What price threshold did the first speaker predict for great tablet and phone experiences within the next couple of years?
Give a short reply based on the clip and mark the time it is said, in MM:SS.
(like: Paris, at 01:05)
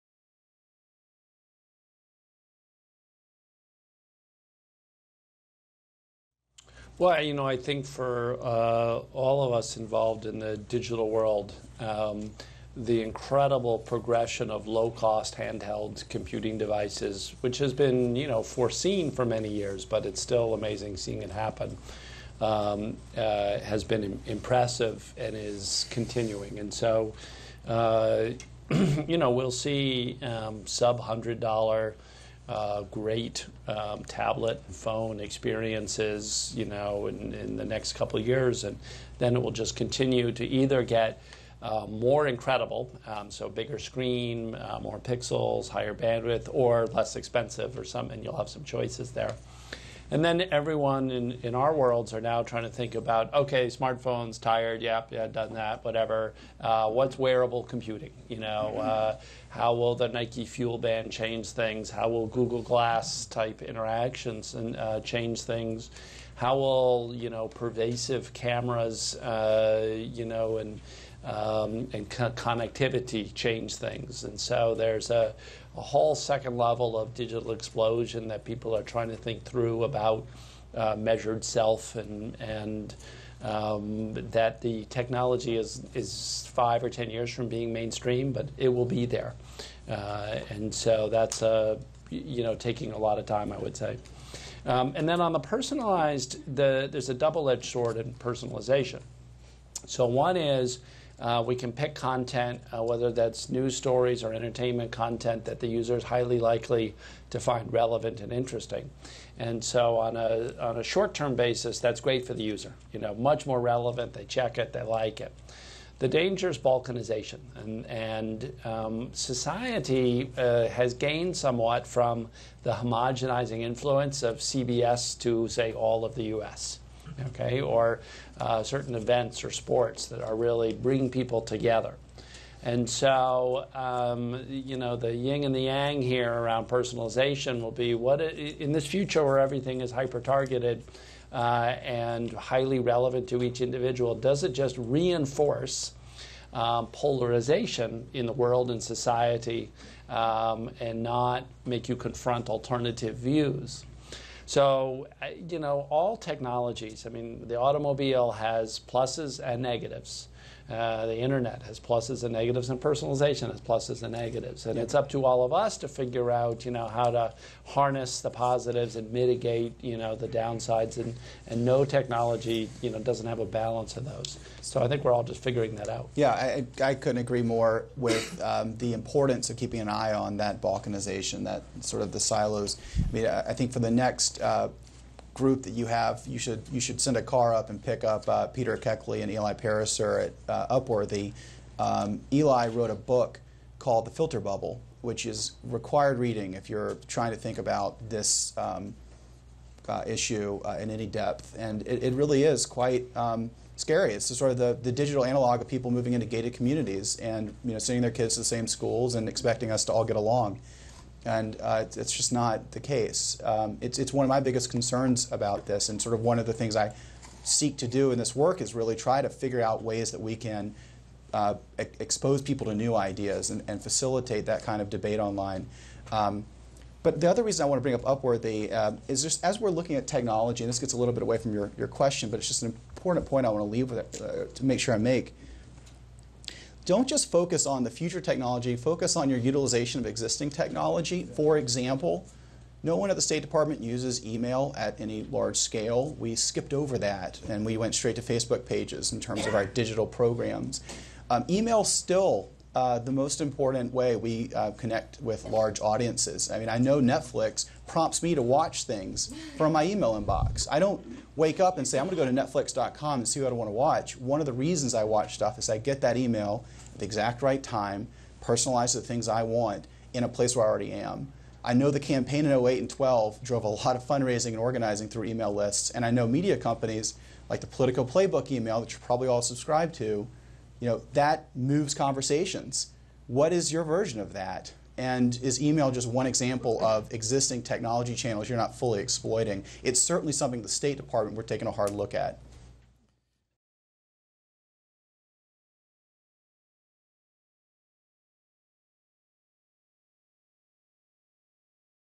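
sub-$100, at 00:30.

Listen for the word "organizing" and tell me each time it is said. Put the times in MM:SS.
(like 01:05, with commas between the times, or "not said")
04:34.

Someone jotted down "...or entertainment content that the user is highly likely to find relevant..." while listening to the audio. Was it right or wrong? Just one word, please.
right.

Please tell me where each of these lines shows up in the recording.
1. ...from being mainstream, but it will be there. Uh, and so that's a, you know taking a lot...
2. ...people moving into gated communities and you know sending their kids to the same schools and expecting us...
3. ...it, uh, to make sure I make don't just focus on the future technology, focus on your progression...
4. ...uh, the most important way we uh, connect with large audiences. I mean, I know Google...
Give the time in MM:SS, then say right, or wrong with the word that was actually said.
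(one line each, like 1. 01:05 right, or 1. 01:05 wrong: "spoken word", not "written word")
1. 01:27 right
2. 03:25 right
3. 03:53 wrong: "utilization", not "progression"
4. 04:12 wrong: "Netflix", not "Google".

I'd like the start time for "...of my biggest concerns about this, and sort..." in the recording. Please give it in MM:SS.
03:34.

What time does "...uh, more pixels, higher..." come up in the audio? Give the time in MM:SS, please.
00:44.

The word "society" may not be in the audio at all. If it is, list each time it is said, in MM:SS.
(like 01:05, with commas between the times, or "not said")
01:59, 02:28.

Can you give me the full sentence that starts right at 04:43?
What is your version of that?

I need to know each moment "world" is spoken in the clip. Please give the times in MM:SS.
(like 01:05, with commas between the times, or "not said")
00:11, 00:51, 02:28.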